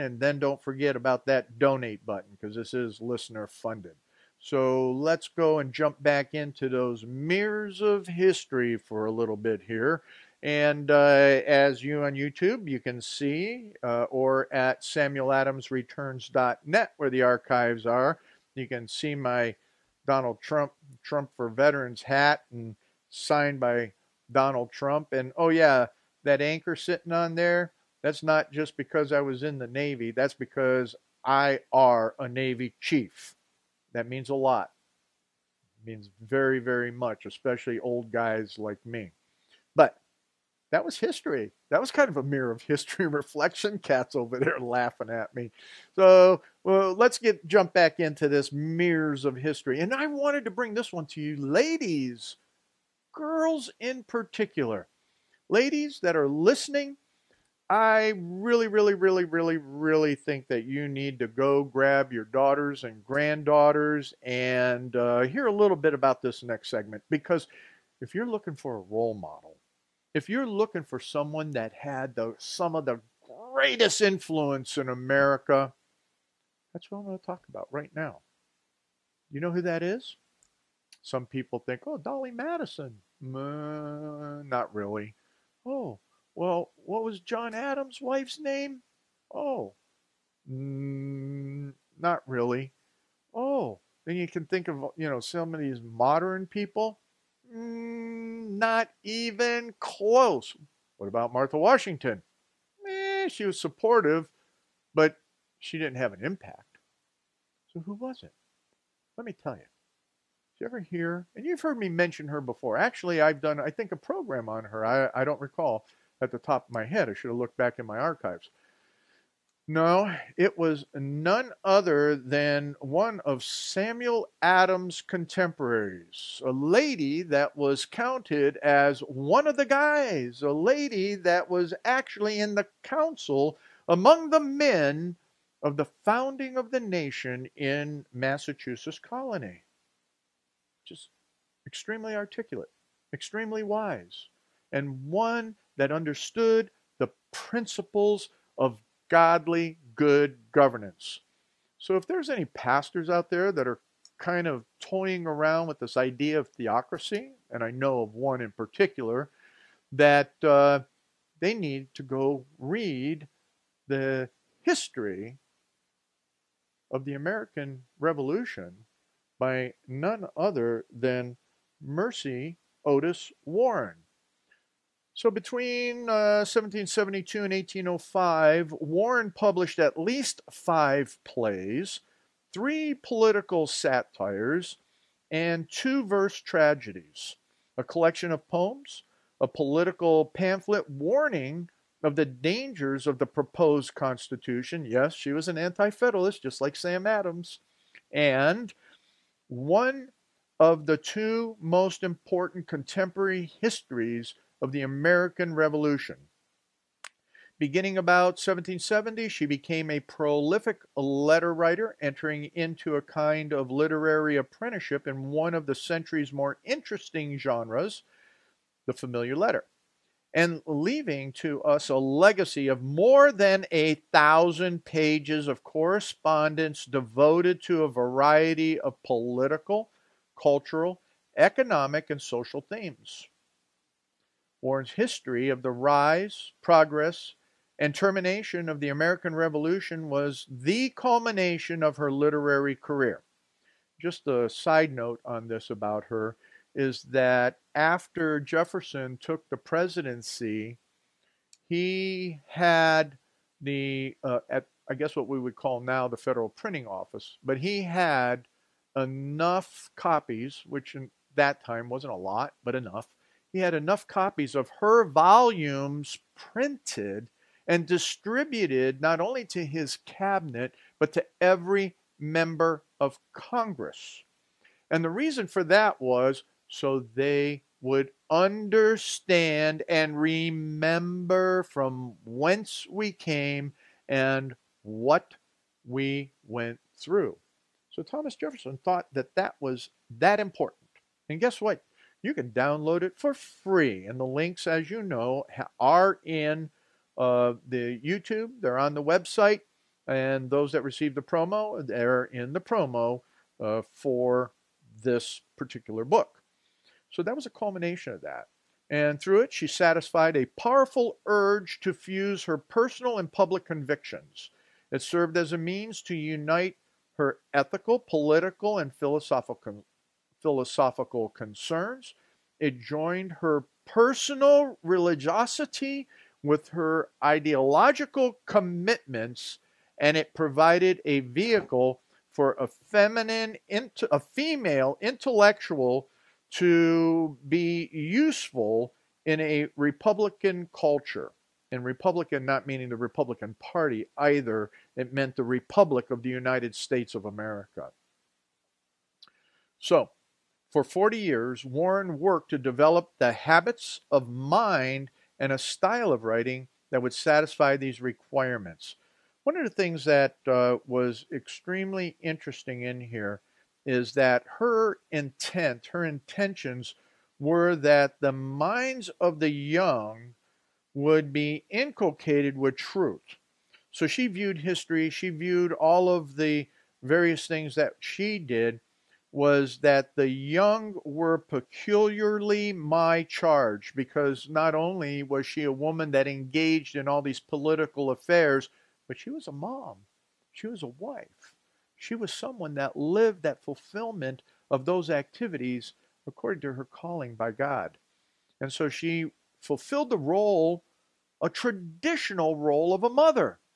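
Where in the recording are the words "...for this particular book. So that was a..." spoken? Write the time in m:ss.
5:03.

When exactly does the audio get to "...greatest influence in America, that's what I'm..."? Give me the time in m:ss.
1:13.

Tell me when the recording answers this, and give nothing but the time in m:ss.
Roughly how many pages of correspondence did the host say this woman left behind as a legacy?
3:42.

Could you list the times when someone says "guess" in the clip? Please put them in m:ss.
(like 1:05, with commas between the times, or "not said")
4:14, 4:51.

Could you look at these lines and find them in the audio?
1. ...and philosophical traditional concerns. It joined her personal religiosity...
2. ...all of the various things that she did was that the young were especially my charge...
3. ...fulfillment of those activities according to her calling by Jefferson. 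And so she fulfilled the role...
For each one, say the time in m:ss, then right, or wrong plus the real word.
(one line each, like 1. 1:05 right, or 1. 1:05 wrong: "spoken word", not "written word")
1. 5:18 wrong: "philosophical", not "traditional"
2. 6:15 wrong: "peculiarly", not "especially"
3. 6:33 wrong: "God", not "Jefferson".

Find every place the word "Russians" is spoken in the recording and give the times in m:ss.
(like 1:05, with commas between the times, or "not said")
not said.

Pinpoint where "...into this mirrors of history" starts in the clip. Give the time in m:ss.
0:47.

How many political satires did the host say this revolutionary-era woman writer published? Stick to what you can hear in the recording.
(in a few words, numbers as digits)
three.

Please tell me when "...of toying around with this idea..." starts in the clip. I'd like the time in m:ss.
2:34.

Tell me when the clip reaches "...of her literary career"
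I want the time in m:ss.
4:01.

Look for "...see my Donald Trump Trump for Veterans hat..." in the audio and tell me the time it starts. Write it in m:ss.
0:18.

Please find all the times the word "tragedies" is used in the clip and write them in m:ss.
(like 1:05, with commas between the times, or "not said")
3:06.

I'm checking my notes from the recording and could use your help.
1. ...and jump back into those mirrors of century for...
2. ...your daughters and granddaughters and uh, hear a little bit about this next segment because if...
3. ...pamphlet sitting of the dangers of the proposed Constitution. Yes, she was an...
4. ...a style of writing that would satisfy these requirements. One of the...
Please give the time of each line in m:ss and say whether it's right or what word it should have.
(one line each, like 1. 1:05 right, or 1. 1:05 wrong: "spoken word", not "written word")
1. 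0:05 wrong: "history", not "century"
2. 1:02 right
3. 3:10 wrong: "warning", not "sitting"
4. 5:55 right.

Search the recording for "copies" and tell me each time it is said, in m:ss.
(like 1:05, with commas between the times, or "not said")
4:19, 4:24.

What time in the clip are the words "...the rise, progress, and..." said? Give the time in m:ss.
3:55.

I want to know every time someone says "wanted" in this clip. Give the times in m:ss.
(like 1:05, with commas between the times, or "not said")
0:50.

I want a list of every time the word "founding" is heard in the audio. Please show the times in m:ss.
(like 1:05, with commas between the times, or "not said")
2:16.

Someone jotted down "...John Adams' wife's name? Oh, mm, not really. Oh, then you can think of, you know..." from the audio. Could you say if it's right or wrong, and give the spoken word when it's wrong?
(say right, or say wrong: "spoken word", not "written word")
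right.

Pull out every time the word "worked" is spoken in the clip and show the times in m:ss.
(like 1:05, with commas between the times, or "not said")
5:52.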